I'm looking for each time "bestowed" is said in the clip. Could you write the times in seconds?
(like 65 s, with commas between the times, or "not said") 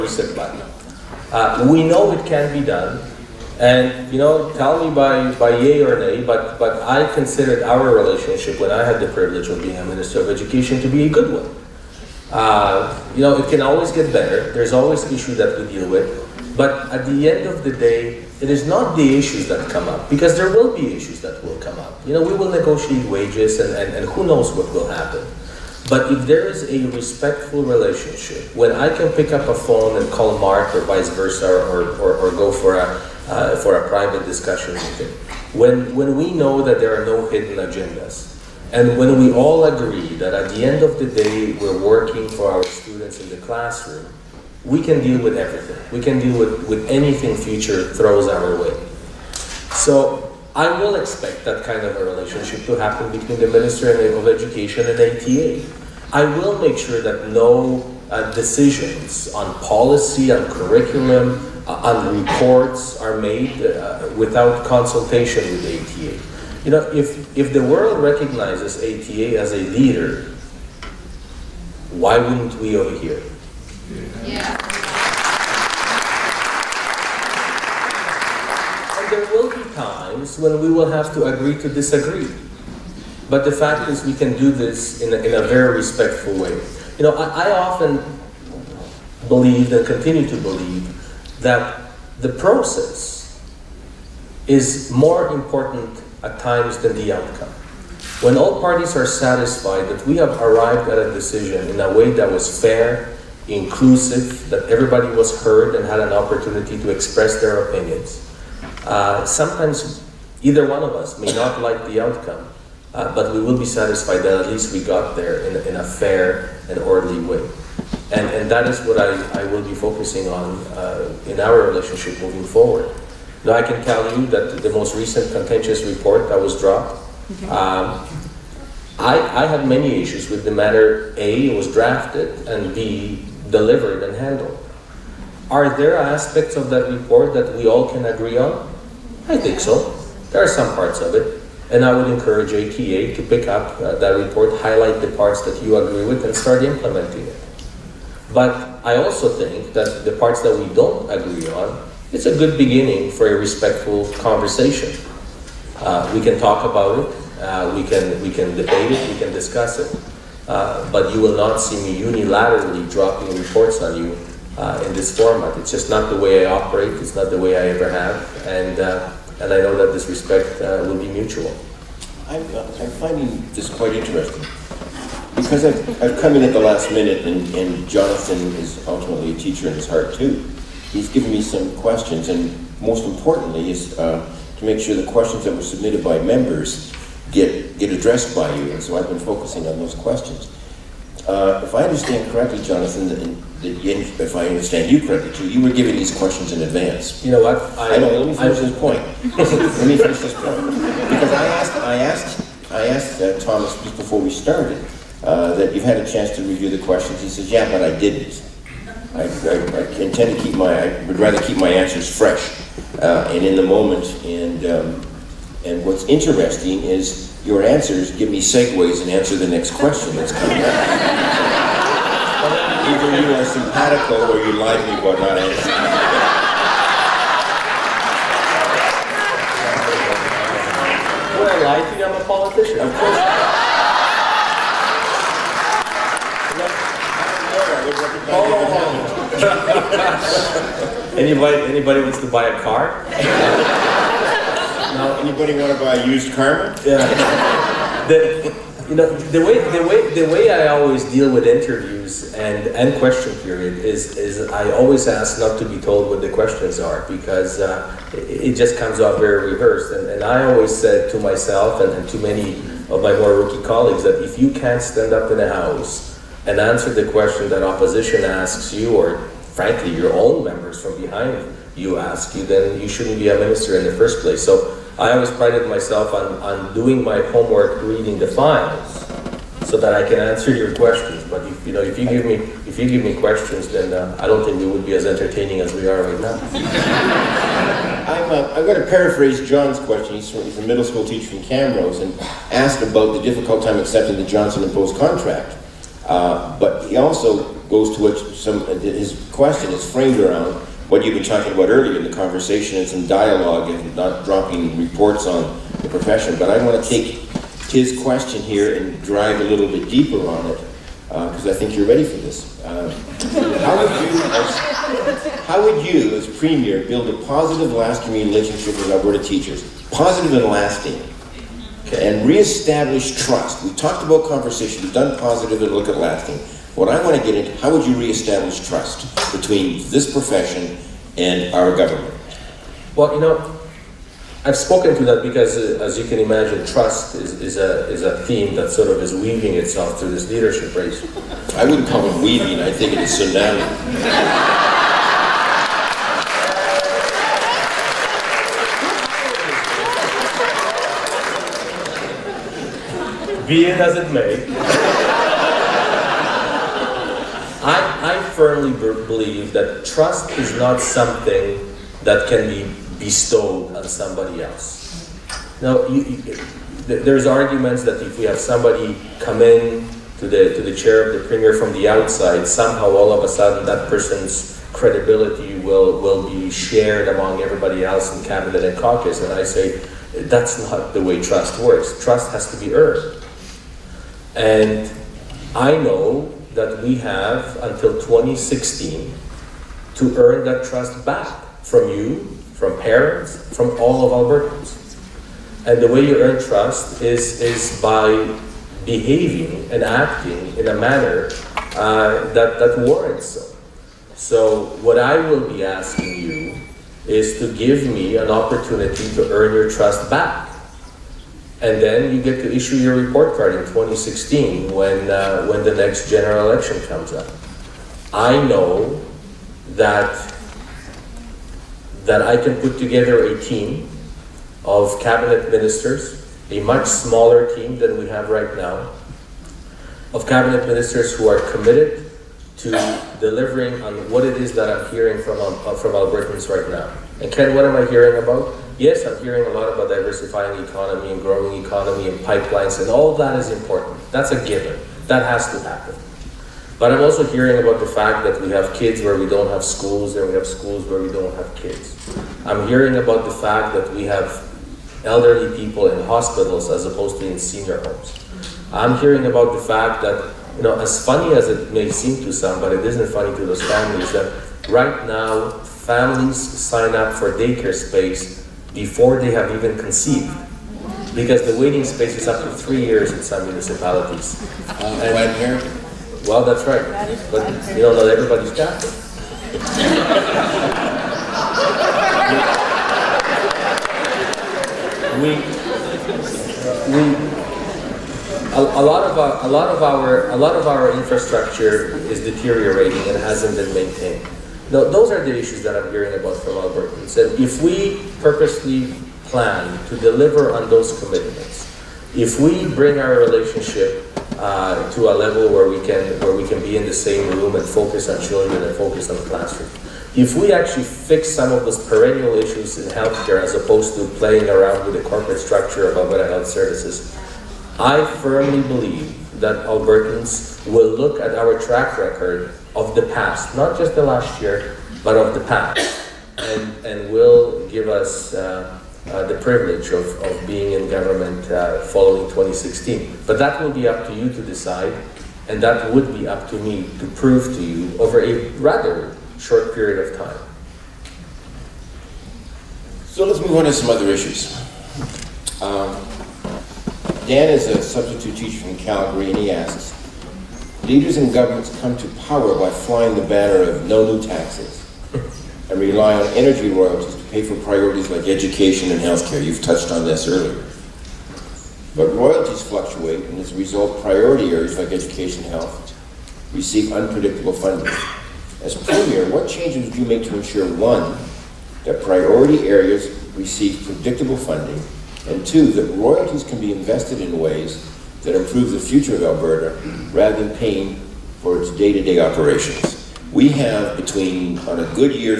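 363 s.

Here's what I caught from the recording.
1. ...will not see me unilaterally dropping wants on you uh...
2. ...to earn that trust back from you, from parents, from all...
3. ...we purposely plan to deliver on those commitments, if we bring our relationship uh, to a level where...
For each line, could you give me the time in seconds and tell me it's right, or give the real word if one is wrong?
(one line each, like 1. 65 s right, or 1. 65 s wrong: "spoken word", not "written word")
1. 161 s wrong: "reports", not "wants"
2. 389 s right
3. 497 s right.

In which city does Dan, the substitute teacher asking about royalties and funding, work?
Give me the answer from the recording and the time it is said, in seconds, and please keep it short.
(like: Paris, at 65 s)
Calgary, at 548 s.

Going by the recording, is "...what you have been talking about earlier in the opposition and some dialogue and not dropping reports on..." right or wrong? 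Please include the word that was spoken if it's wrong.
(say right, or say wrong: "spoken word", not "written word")
wrong: "conversation", not "opposition".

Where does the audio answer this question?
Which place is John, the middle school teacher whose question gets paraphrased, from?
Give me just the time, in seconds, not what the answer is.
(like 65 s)
291 s.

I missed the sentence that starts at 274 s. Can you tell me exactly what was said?
So I always prided myself on, on doing my homework, reading the files, so that I can answer your questions.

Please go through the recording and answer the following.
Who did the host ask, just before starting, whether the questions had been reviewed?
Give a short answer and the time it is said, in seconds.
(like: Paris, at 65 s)
Thomas, at 203 s.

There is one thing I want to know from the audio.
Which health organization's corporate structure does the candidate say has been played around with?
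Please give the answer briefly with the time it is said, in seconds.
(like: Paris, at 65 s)
Alberta Health Services, at 515 s.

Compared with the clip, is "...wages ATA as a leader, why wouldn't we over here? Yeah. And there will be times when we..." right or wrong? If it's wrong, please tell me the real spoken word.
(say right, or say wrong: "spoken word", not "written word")
wrong: "recognizes", not "wages".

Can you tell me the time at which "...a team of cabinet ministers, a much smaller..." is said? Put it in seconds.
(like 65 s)
423 s.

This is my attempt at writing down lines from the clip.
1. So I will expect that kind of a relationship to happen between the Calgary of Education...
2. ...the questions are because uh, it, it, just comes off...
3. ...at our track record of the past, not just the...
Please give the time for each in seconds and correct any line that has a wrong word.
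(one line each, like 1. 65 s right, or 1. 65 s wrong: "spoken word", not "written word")
1. 49 s wrong: "Ministry", not "Calgary"
2. 256 s right
3. 521 s right.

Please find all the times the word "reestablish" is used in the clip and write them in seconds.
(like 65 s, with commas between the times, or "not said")
322 s, 327 s.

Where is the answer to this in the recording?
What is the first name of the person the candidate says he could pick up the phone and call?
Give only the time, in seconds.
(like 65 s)
30 s.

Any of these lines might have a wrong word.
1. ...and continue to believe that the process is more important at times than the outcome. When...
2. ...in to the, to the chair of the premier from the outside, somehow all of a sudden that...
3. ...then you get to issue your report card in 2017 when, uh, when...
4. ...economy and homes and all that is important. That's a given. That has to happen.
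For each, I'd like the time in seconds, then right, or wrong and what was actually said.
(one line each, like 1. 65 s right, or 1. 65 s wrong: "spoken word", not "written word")
1. 89 s right
2. 369 s right
3. 411 s wrong: "2016", not "2017"
4. 441 s wrong: "pipelines", not "homes".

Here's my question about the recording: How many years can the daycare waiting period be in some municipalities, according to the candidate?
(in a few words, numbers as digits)
3 years.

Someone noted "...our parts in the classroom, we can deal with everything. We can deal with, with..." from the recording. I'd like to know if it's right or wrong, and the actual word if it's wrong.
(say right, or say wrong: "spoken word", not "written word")
wrong: "students", not "parts".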